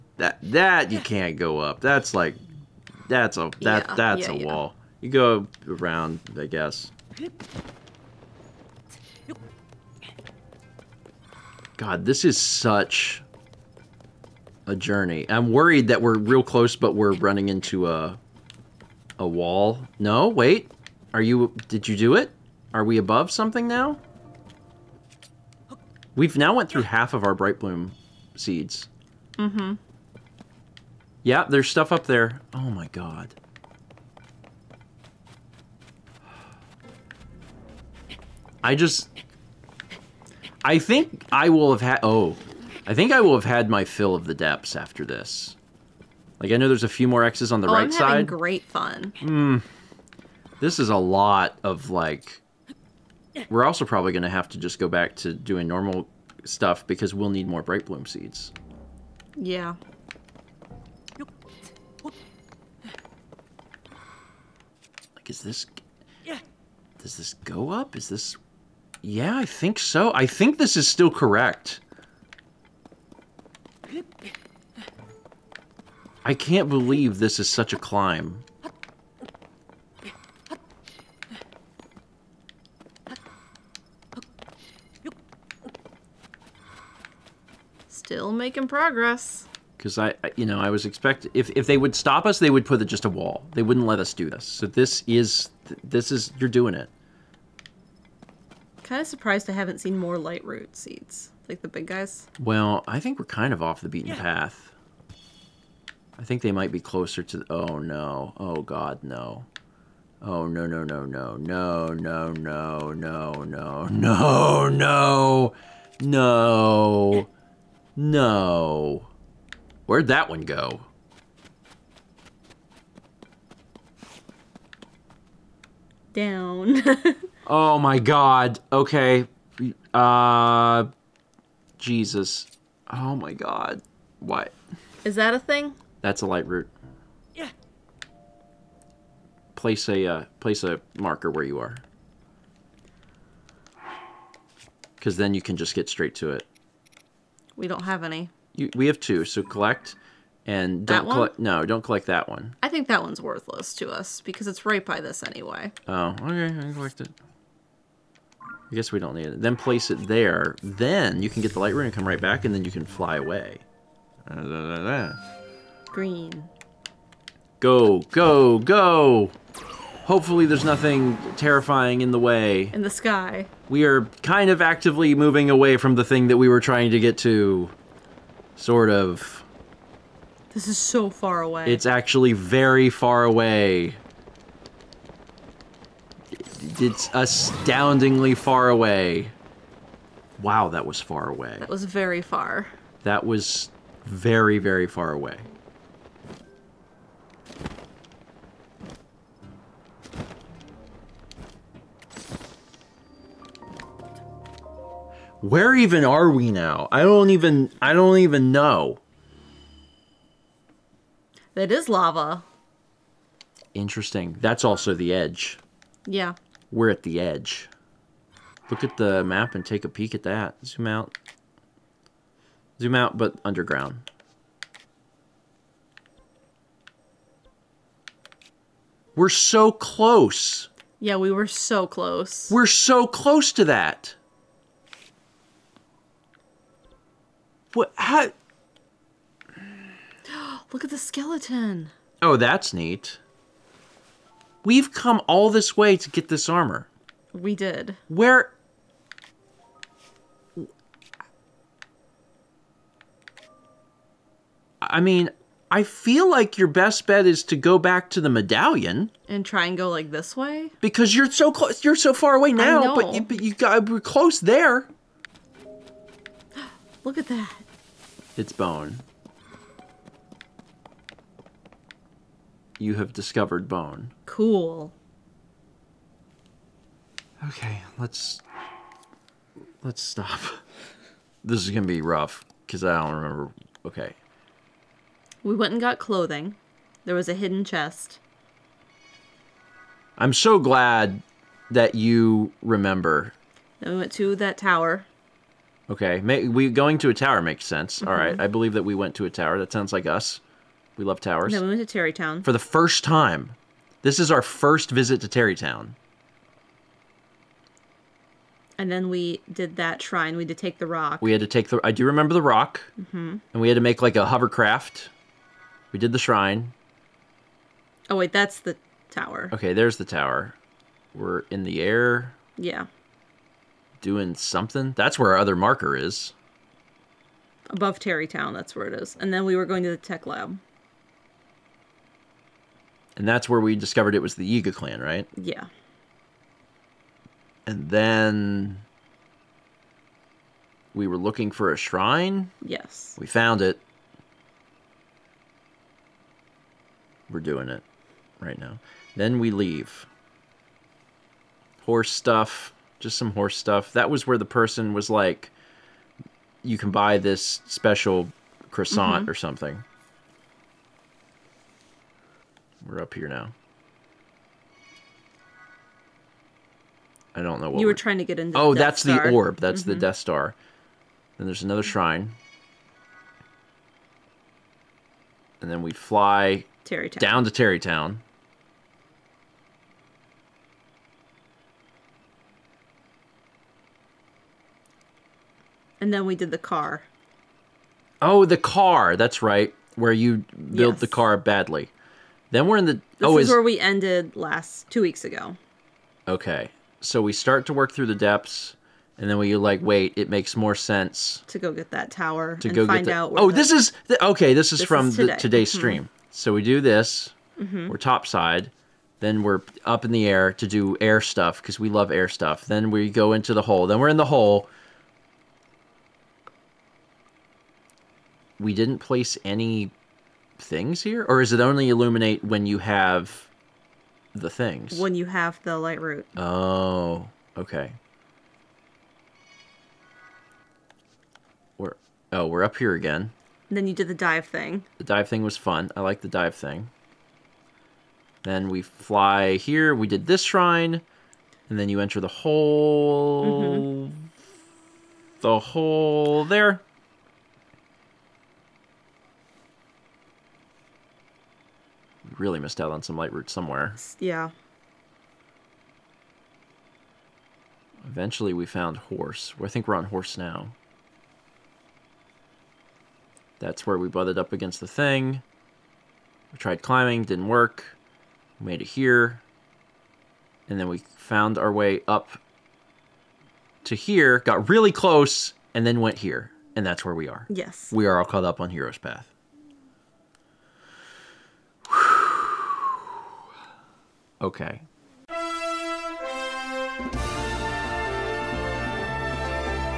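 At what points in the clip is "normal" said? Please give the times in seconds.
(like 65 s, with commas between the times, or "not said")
55 s.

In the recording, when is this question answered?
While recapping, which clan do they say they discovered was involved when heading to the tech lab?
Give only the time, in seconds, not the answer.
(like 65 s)
334 s.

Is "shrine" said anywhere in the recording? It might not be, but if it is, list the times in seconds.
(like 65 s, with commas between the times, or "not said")
310 s, 316 s, 341 s, 371 s, 440 s.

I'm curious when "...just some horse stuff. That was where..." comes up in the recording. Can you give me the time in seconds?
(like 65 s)
352 s.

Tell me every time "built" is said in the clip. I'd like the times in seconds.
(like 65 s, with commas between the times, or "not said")
390 s.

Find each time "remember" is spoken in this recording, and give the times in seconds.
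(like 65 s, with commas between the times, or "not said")
283 s, 292 s, 312 s.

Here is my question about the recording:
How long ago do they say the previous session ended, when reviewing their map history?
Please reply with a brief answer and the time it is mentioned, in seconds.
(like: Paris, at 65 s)
two weeks ago, at 394 s.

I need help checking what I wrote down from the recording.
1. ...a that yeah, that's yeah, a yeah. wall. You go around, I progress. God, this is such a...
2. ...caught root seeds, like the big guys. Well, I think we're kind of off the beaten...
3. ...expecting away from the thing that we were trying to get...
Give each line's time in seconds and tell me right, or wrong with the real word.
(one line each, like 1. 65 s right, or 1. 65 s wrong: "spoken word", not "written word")
1. 3 s wrong: "guess", not "progress"
2. 100 s wrong: "light", not "caught"
3. 175 s wrong: "moving", not "expecting".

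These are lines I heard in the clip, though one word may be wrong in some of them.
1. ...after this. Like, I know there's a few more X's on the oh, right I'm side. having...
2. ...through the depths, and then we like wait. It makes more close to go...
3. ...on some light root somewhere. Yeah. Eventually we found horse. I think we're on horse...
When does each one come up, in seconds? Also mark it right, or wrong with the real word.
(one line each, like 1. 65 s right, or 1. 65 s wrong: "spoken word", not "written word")
1. 44 s right
2. 397 s wrong: "sense", not "close"
3. 452 s right.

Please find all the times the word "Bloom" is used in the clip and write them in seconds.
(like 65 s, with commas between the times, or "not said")
27 s, 57 s.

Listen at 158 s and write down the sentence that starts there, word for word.
I guess we don't need it.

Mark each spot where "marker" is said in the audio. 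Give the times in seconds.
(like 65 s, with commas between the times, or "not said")
140 s, 325 s.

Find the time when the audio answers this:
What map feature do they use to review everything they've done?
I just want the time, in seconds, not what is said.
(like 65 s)
478 s.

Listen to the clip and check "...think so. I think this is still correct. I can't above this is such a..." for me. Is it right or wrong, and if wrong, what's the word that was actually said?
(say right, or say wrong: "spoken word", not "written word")
wrong: "believe", not "above".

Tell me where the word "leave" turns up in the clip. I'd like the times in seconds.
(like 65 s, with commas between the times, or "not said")
349 s.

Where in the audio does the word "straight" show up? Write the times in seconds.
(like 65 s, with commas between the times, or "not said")
145 s.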